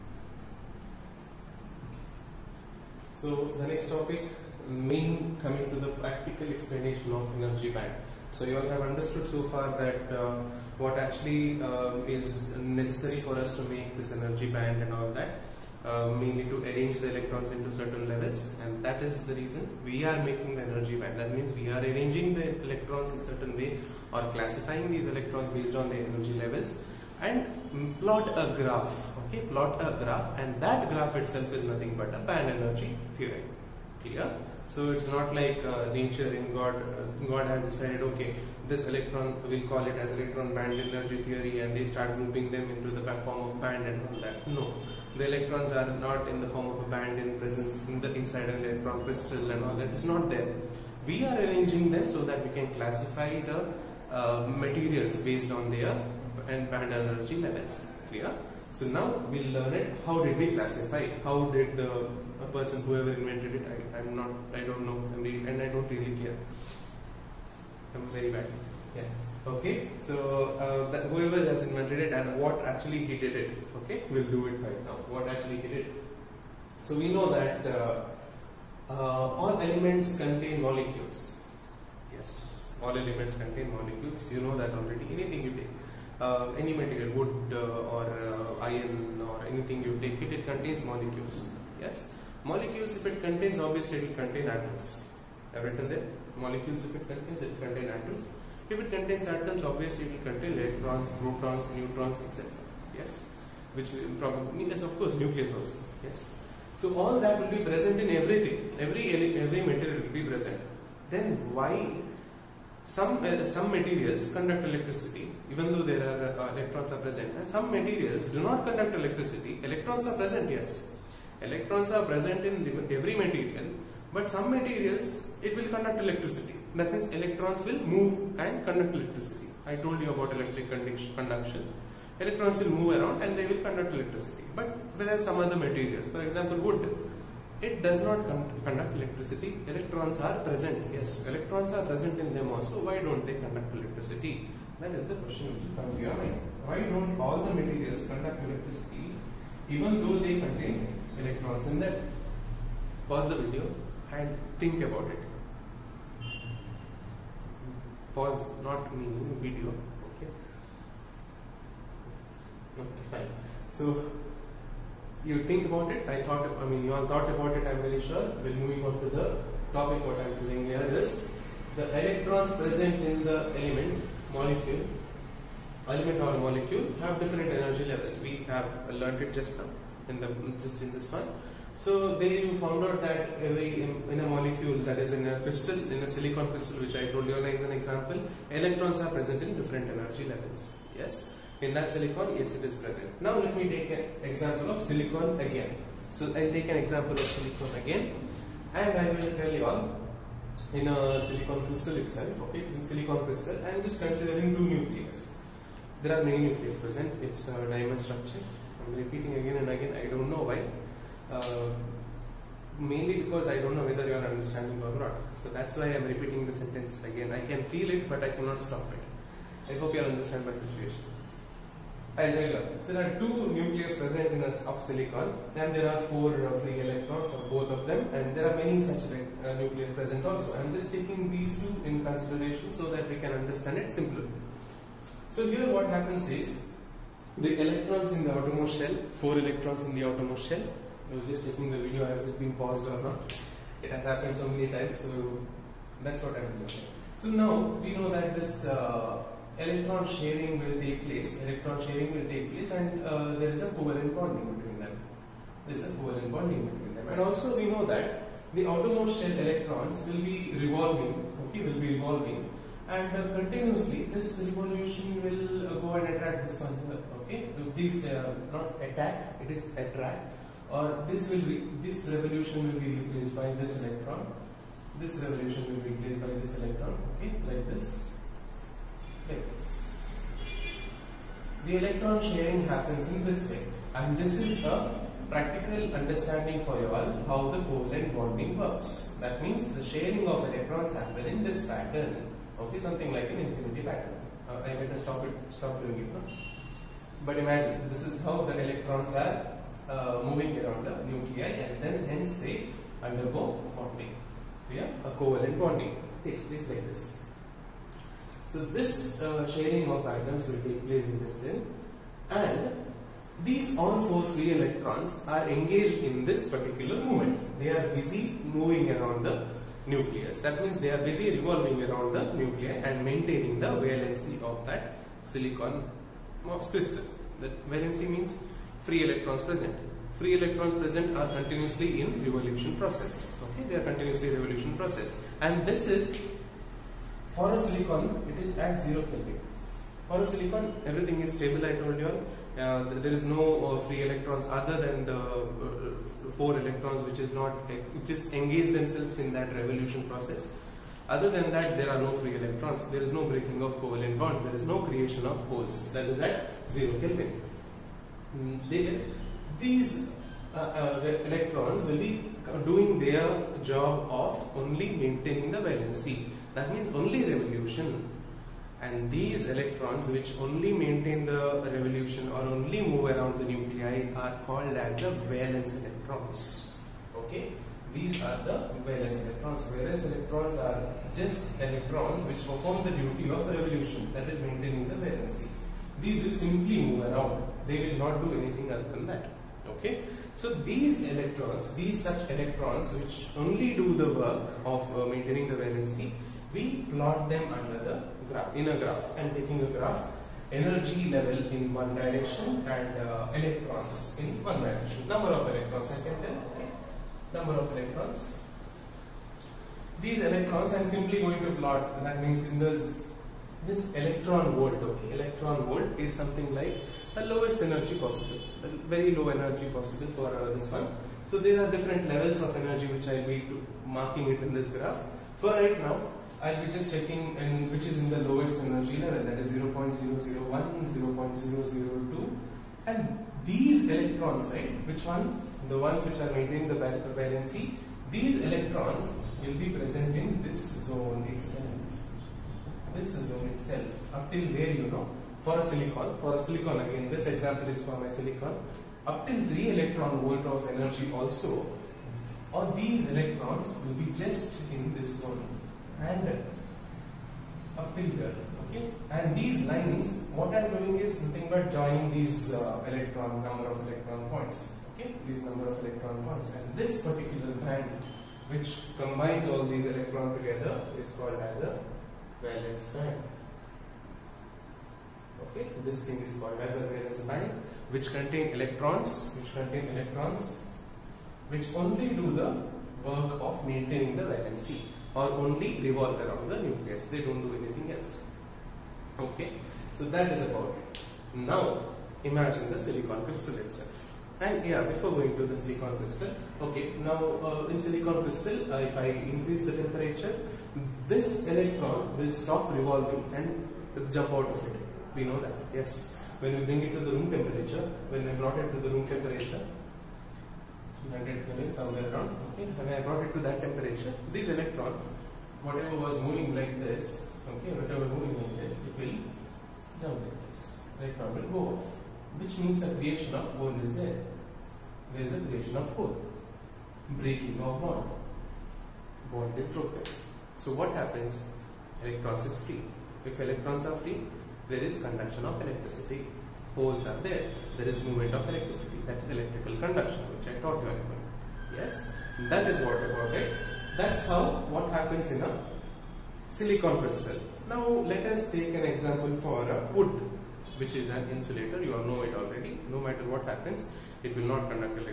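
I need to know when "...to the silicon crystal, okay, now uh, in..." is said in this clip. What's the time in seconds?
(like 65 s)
495 s.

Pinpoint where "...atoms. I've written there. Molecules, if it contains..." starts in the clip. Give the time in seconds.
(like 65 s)
94 s.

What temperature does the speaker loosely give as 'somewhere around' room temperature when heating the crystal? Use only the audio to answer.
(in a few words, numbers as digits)
100 Kelvin.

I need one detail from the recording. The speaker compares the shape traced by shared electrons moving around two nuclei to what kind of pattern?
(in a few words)
infinity pattern.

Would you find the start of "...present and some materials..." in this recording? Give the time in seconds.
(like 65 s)
116 s.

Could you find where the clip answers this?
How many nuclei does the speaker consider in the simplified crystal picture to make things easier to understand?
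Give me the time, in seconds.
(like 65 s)
203 s.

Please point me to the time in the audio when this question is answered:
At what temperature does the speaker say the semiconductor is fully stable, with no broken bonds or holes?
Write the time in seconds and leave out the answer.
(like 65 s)
338 s.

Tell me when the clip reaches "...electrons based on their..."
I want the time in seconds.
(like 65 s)
25 s.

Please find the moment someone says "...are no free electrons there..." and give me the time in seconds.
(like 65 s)
351 s.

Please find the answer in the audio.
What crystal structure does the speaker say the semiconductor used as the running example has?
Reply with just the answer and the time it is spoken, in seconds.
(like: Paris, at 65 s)
diamond structure, at 207 s.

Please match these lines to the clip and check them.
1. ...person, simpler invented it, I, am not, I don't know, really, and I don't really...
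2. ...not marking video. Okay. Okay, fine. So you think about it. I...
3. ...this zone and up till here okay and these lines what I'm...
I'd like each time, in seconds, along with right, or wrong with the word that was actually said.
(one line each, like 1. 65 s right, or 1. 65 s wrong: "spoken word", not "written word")
1. 62 s wrong: "whoever", not "simpler"
2. 158 s wrong: "meaning", not "marking"
3. 454 s right.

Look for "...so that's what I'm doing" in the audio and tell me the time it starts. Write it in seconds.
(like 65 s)
244 s.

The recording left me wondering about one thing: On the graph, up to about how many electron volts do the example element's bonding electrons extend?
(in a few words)
3 electron volt.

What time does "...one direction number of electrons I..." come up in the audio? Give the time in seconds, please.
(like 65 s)
404 s.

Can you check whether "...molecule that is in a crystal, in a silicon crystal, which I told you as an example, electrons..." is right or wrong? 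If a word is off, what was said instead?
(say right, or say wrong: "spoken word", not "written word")
right.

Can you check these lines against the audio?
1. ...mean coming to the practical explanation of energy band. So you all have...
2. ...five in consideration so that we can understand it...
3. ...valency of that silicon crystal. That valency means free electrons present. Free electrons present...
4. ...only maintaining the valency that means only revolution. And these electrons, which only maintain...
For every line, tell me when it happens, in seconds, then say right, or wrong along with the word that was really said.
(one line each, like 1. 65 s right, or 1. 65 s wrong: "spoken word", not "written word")
1. 4 s right
2. 231 s wrong: "two", not "five"
3. 323 s right
4. 364 s right.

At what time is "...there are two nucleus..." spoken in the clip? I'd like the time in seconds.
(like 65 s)
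222 s.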